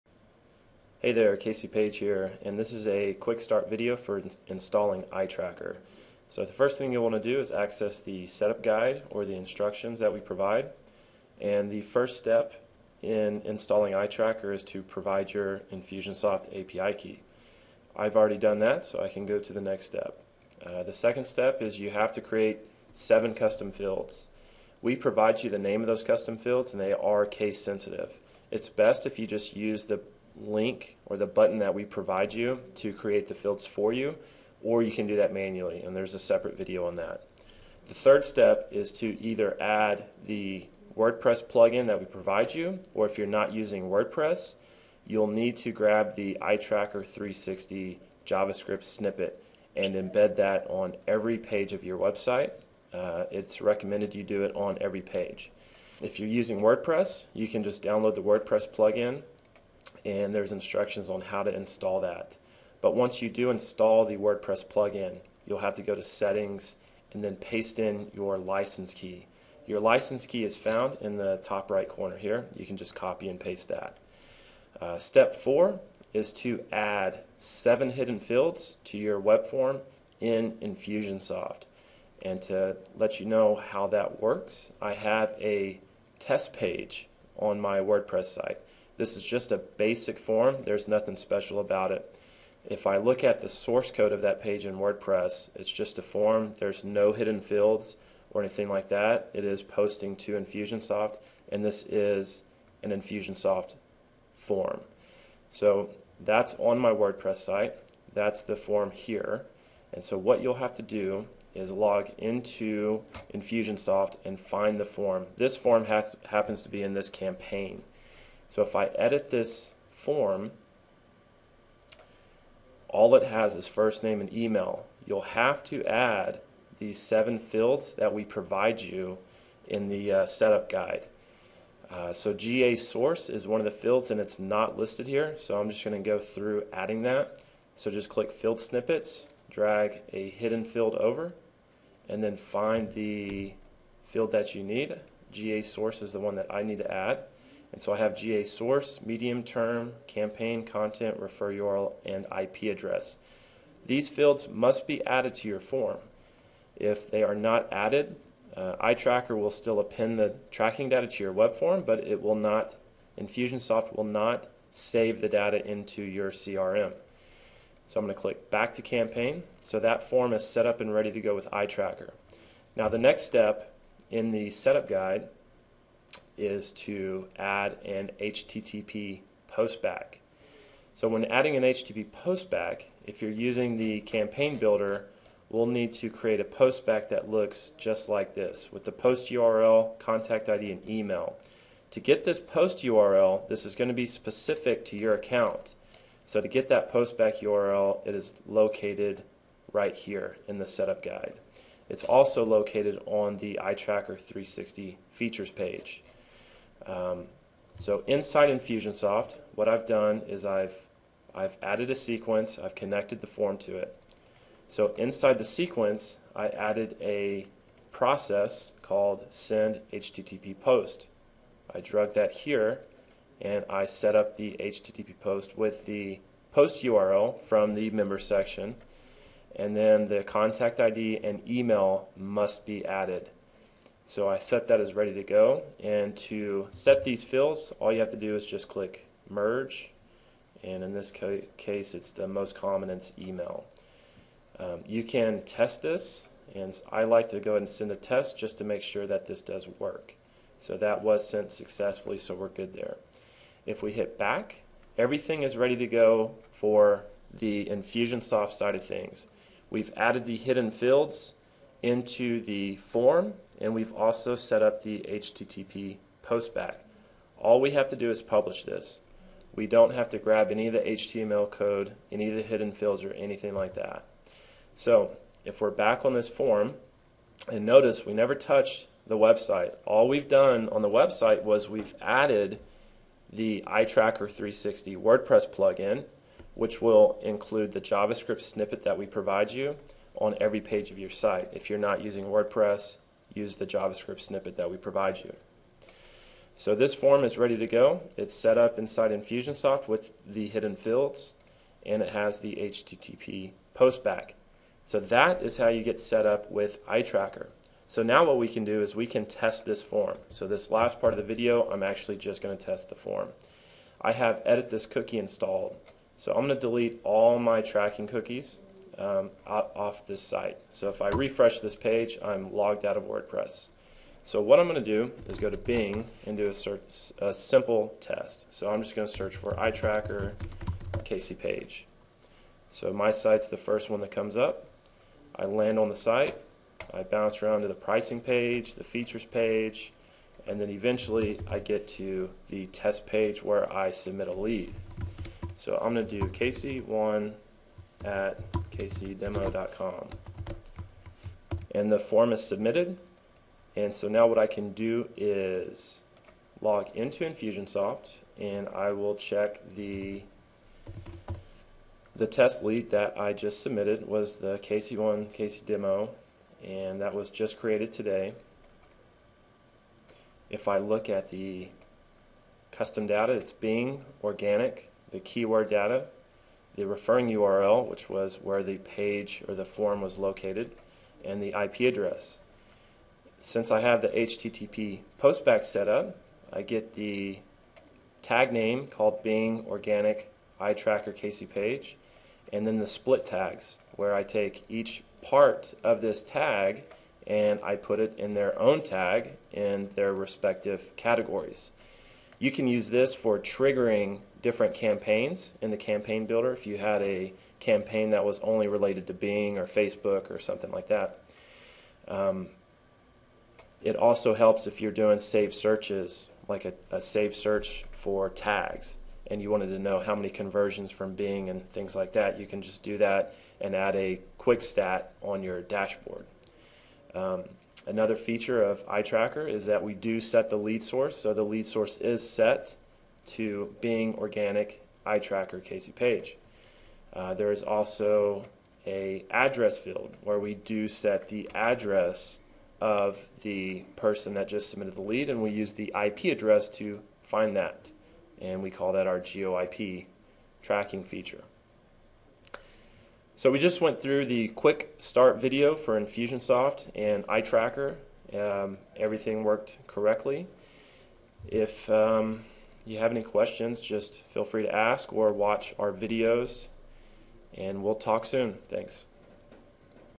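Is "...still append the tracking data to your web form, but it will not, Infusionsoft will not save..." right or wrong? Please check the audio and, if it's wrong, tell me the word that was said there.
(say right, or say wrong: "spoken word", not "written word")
right.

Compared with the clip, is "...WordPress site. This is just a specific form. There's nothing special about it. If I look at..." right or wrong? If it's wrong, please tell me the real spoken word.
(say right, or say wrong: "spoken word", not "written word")
wrong: "basic", not "specific".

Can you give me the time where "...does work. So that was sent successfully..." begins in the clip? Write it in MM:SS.
04:09.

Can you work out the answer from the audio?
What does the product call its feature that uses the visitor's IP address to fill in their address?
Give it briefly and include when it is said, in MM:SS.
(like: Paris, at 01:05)
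GeoIP tracking, at 07:29.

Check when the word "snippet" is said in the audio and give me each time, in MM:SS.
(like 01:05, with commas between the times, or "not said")
00:48, 02:18, 04:48, 04:54.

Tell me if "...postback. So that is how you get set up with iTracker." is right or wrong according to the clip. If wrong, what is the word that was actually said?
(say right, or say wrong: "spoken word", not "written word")
right.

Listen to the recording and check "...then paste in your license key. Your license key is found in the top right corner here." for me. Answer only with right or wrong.
right.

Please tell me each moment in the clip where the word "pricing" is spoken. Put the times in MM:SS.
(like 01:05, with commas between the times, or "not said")
05:37.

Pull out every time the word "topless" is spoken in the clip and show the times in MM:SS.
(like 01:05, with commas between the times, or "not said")
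not said.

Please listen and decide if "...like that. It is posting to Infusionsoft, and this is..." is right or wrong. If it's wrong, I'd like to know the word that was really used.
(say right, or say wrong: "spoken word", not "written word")
right.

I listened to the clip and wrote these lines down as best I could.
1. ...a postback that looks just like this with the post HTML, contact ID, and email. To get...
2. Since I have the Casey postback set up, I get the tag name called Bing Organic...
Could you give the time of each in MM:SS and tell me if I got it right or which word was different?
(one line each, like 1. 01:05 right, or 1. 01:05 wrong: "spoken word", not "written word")
1. 03:06 wrong: "URL", not "HTML"
2. 06:23 wrong: "HTTP", not "Casey".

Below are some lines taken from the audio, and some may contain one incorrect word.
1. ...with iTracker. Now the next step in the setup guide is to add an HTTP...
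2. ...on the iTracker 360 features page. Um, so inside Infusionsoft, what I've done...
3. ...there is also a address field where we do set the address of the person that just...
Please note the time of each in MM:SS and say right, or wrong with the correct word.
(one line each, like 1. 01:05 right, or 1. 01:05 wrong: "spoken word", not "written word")
1. 02:51 right
2. 03:23 right
3. 07:17 right.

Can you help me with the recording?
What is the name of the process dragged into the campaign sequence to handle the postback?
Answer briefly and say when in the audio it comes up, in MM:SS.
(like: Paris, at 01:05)
Send HTTP post, at 03:39.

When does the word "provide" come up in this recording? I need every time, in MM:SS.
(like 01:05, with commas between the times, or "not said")
00:10, 00:14, 00:24, 00:31, 00:42, 02:08, 04:49, 04:54.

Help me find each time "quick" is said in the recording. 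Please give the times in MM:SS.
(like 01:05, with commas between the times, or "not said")
00:03, 07:04, 07:34.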